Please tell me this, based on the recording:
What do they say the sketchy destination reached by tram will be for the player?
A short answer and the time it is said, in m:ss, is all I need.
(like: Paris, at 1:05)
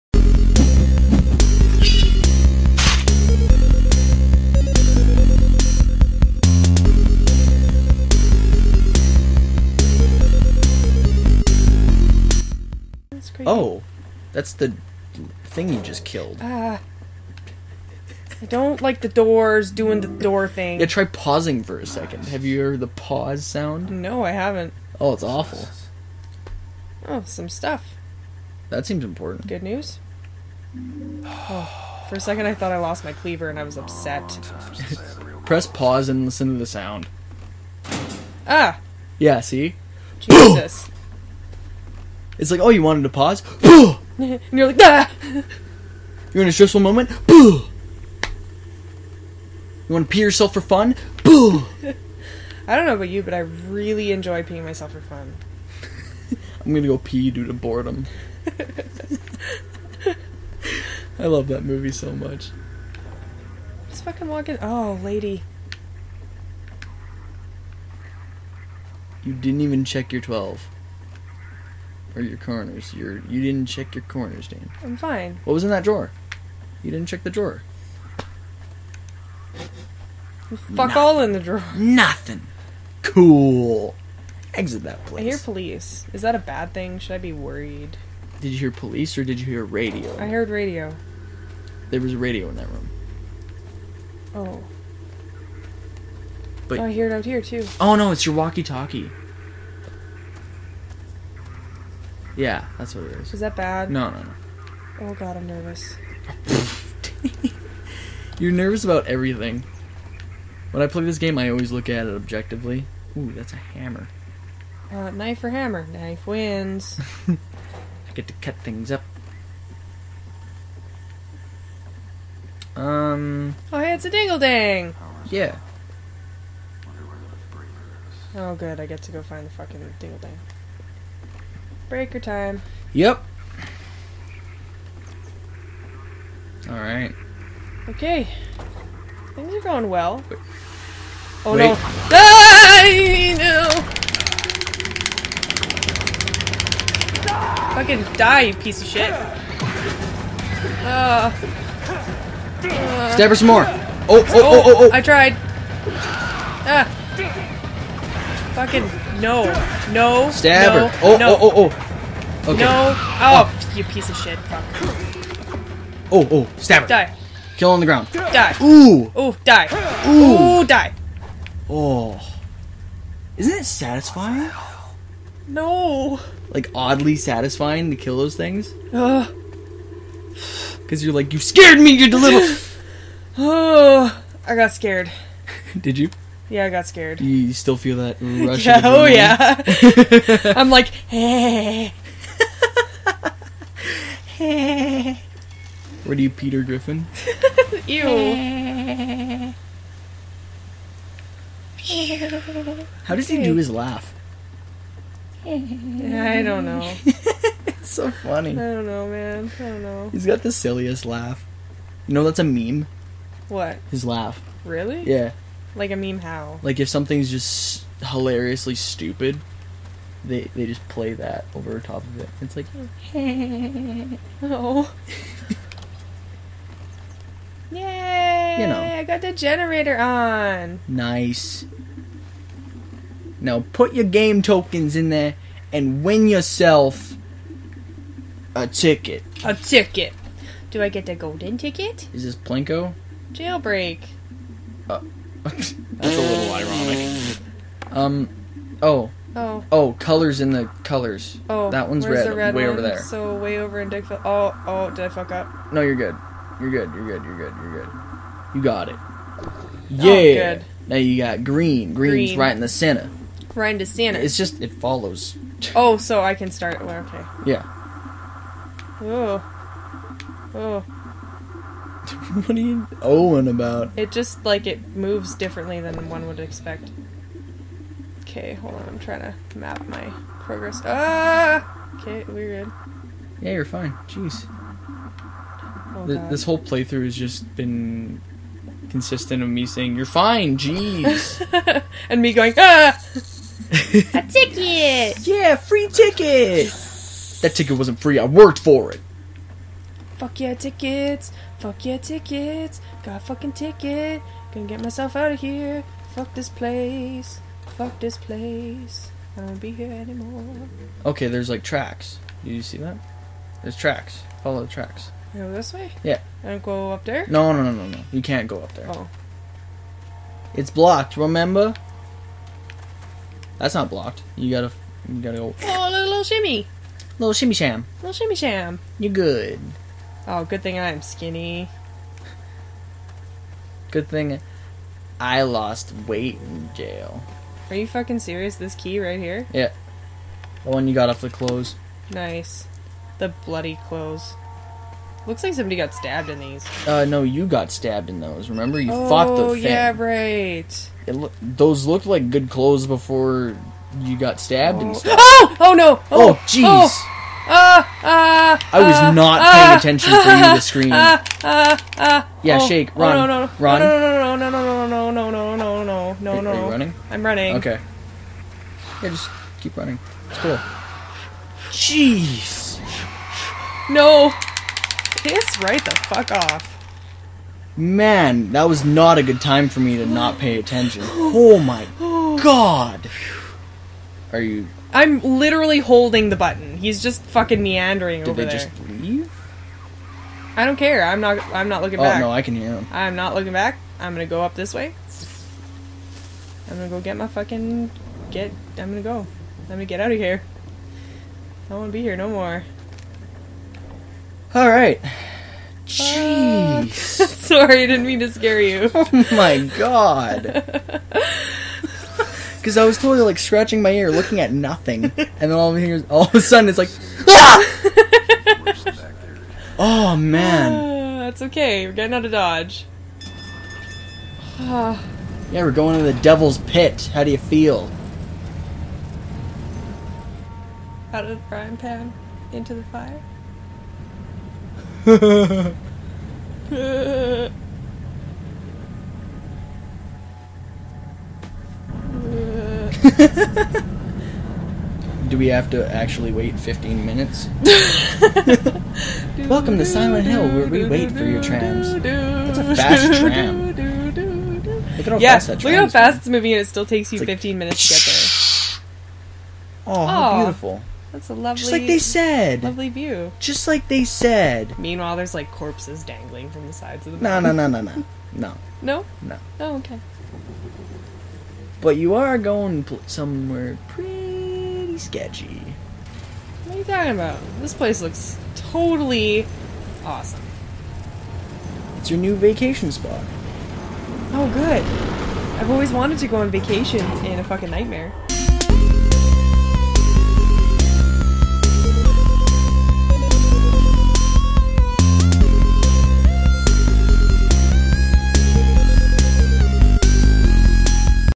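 New vacation spot, at 8:02.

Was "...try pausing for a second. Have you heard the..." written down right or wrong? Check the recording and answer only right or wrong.
right.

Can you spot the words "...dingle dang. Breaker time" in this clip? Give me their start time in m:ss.
2:09.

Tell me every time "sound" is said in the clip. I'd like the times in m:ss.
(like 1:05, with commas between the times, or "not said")
0:23, 0:36.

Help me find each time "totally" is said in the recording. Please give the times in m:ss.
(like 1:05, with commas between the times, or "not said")
6:52, 7:58.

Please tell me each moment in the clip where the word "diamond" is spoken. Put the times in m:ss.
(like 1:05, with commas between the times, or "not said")
not said.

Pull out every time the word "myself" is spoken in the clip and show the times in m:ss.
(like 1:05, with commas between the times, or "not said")
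0:54, 5:04.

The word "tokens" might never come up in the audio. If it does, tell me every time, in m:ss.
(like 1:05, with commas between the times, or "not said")
3:54.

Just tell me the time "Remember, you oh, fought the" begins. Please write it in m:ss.
5:48.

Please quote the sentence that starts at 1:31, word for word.
There was a radio in that room.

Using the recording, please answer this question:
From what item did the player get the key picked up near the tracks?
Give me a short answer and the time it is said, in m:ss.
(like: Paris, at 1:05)
The bloody clothes, at 5:43.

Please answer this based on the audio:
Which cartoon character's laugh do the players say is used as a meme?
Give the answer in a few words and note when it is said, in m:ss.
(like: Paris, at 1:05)
Peter Griffin, at 3:16.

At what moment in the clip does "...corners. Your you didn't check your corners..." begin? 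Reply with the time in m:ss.
1:12.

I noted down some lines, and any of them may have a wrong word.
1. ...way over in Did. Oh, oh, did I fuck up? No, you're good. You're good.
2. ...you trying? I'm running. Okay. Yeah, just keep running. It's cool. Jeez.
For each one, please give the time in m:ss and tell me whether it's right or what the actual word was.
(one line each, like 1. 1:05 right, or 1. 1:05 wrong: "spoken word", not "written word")
1. 4:13 wrong: "Dickville", not "Did"
2. 6:06 wrong: "running", not "trying".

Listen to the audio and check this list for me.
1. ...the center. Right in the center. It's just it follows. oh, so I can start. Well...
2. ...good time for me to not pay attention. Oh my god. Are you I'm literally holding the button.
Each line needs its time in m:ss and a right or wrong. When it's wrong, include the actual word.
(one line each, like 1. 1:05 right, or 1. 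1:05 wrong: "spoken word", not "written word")
1. 4:22 right
2. 6:19 right.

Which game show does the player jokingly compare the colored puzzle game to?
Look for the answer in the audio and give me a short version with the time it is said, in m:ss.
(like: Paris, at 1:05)
Plinko, at 4:02.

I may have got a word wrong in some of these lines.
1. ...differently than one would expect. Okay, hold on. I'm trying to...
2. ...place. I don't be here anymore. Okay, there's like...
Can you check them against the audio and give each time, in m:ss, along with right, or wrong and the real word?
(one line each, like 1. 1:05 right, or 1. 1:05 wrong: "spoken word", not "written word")
1. 4:35 right
2. 5:08 right.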